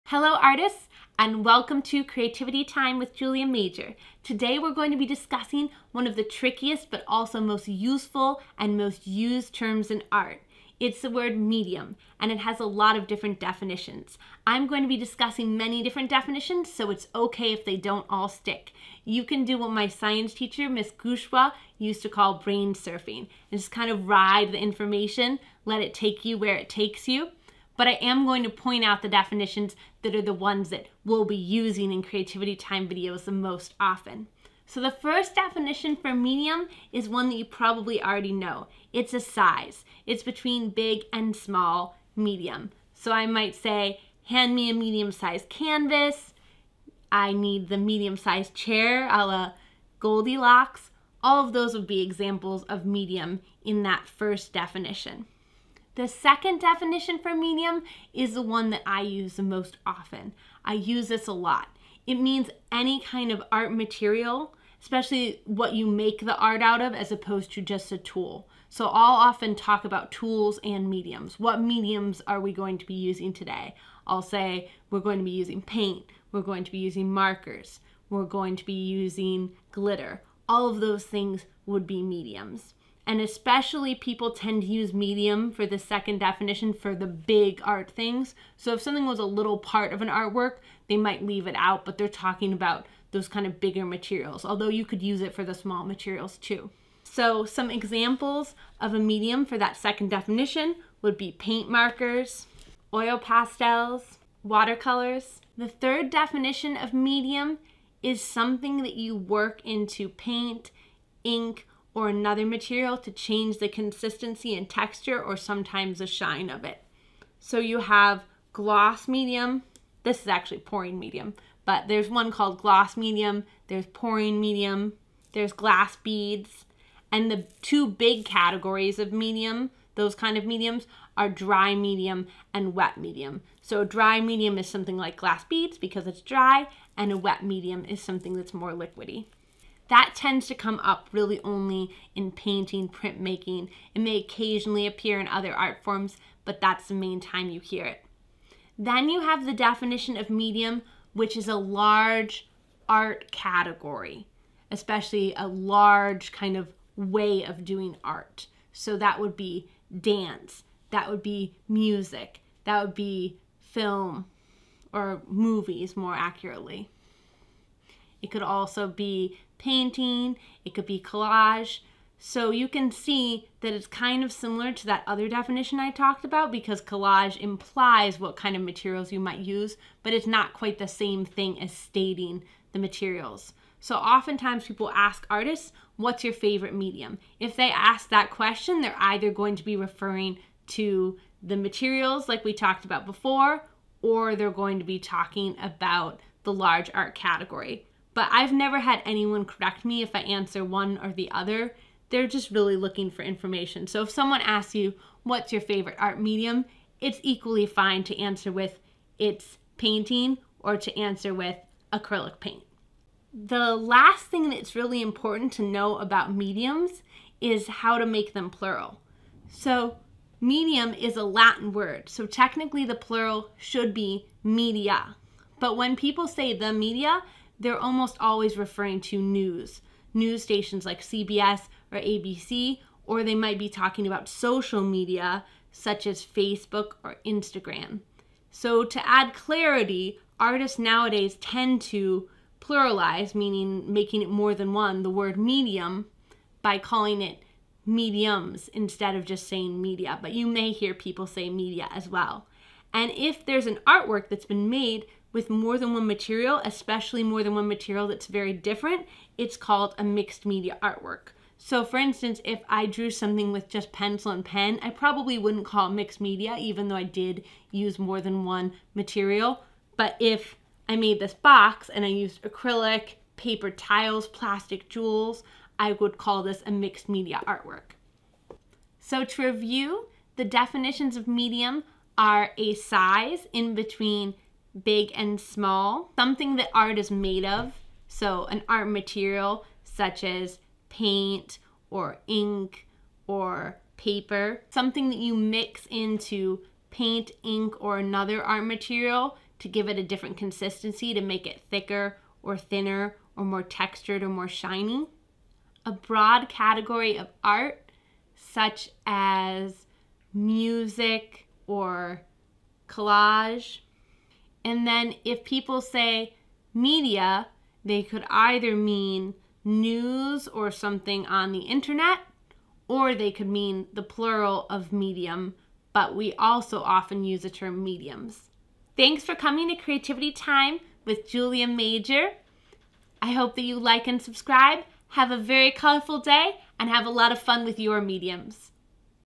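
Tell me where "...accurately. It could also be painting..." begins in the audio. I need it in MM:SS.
02:46.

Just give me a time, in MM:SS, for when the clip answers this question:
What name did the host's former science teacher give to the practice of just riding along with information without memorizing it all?
00:22.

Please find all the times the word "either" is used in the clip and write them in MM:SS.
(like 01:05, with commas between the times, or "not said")
03:08, 05:18.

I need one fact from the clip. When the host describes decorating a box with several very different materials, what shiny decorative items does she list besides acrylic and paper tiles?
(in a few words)
plastic jewels.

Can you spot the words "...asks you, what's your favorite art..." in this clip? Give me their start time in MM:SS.
03:24.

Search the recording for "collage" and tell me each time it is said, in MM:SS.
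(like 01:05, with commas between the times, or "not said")
02:50, 02:56, 05:12.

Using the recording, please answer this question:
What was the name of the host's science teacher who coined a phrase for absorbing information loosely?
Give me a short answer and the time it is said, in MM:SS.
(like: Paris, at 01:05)
Miss Gushwa, at 00:20.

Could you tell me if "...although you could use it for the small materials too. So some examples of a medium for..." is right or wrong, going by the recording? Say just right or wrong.
right.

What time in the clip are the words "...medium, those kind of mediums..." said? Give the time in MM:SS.
02:09.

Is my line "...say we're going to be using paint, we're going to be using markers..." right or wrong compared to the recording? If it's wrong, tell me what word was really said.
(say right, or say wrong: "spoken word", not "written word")
right.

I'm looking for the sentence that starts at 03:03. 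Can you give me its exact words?
So oftentimes people ask artists, what's your favorite medium?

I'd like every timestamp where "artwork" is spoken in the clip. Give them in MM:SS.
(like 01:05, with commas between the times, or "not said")
01:30, 04:13, 04:20, 04:37.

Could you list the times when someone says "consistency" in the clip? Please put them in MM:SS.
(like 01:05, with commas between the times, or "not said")
01:53, 05:00.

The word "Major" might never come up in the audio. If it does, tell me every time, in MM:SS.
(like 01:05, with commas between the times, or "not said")
00:03, 05:31.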